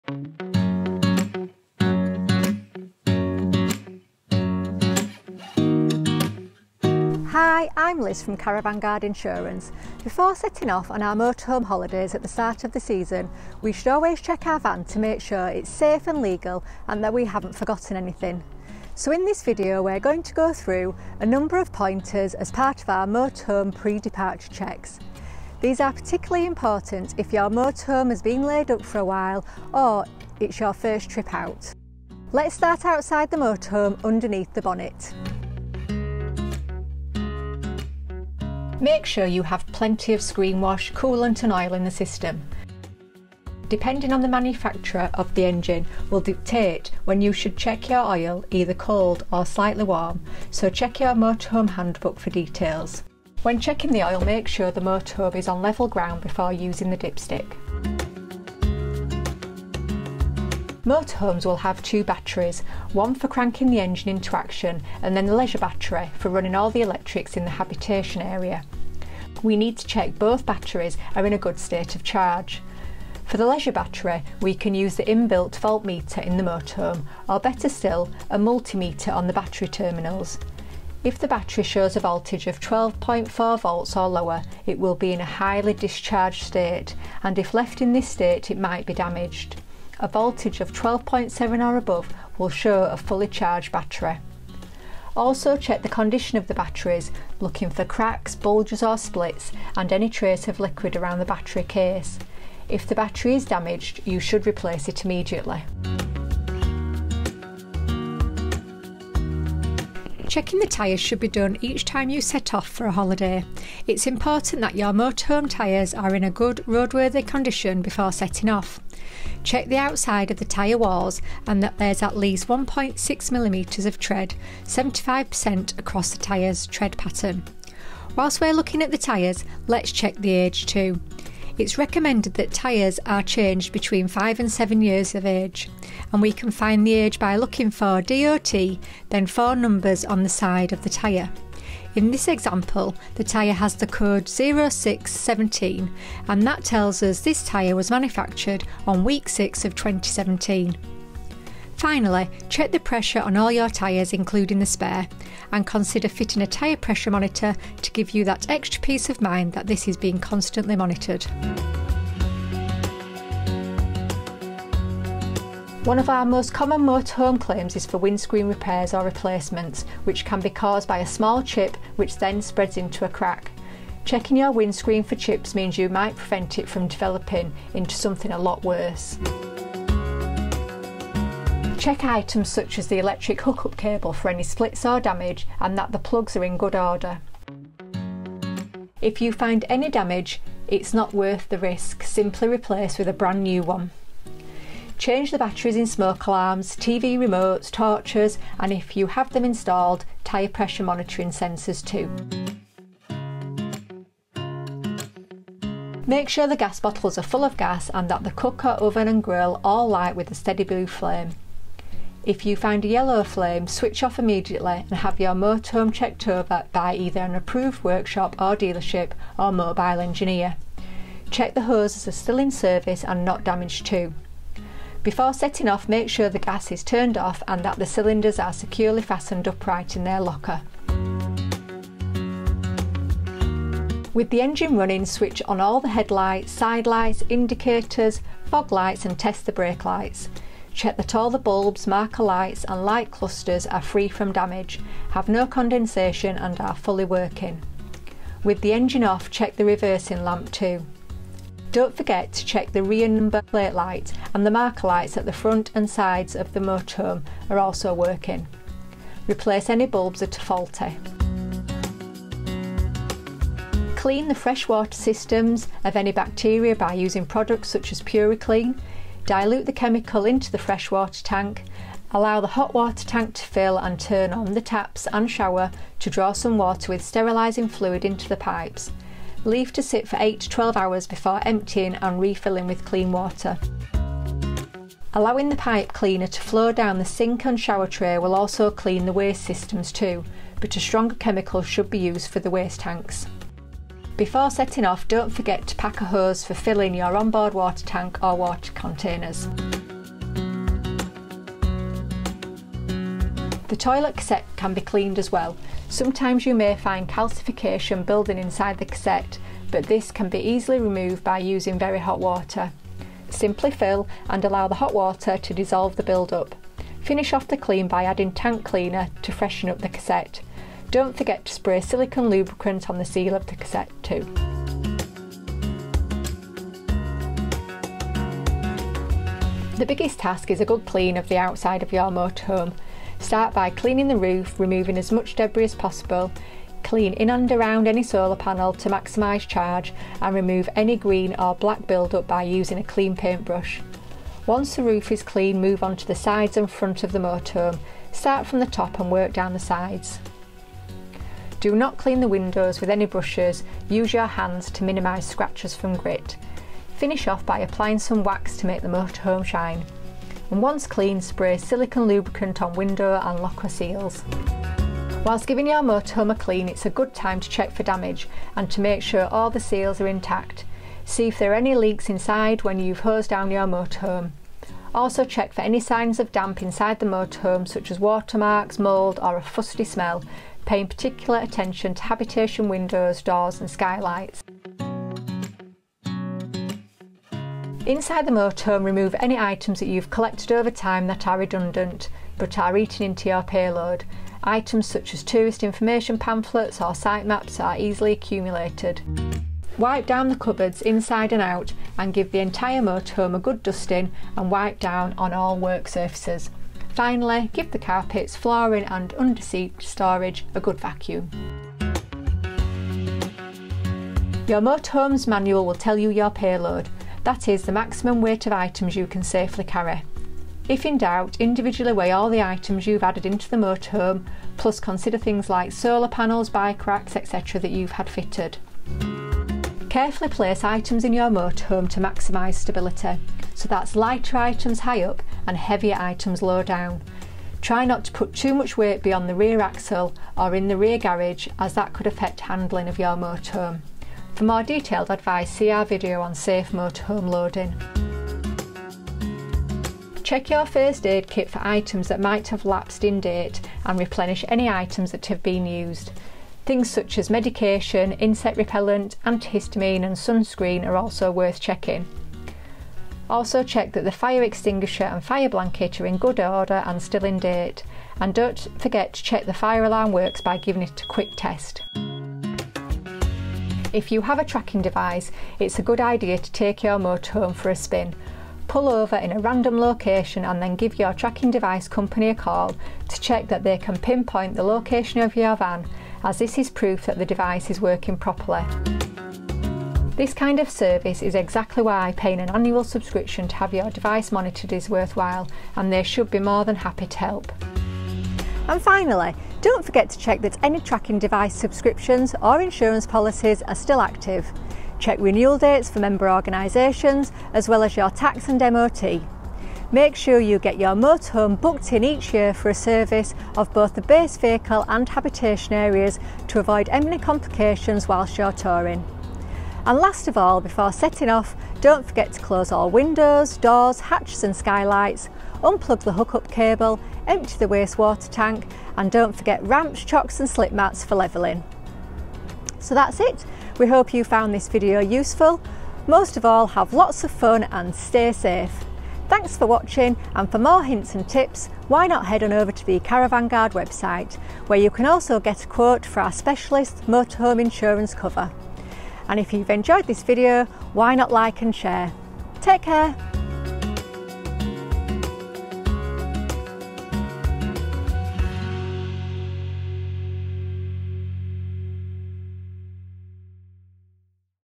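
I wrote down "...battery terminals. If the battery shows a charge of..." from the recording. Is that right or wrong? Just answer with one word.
wrong.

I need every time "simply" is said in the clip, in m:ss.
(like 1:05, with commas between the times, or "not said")
3:12, 5:13.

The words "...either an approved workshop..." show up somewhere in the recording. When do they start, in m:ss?
3:36.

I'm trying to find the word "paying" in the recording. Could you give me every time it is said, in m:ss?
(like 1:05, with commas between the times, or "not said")
6:20, 8:12.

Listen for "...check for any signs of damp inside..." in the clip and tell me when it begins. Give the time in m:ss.
6:15.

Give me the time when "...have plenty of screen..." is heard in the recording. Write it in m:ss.
0:39.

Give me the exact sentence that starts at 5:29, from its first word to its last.
The biggest task is a good clean of the outside of your motorhome.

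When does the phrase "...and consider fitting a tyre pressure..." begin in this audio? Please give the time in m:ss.
2:35.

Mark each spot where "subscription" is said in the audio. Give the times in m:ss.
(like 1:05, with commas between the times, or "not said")
8:12, 8:21.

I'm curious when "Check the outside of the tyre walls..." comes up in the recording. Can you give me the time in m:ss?
1:59.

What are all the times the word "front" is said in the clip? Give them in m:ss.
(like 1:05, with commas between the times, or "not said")
4:15, 5:46.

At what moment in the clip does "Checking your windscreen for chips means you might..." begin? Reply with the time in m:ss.
2:54.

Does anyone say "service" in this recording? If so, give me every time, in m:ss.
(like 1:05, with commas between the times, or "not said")
3:42, 8:10, 8:32.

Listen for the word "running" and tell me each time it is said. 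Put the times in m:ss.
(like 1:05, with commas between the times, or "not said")
1:06, 3:54.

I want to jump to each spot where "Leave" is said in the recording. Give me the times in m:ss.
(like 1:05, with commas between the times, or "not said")
4:39.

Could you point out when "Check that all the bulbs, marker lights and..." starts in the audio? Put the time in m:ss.
4:00.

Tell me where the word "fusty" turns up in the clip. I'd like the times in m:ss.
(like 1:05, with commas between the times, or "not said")
6:19.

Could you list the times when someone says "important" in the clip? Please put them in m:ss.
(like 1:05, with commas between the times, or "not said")
0:26, 1:54.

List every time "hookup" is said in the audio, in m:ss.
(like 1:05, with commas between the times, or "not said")
3:03, 8:46.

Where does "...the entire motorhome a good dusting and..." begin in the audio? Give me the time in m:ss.
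6:42.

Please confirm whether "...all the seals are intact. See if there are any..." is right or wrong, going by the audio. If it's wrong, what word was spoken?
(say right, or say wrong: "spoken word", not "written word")
right.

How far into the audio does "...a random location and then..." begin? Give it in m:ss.
7:59.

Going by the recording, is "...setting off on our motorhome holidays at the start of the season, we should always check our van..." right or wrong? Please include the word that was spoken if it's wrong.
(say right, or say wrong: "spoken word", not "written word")
right.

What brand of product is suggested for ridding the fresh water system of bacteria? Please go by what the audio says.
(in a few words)
PuriClean.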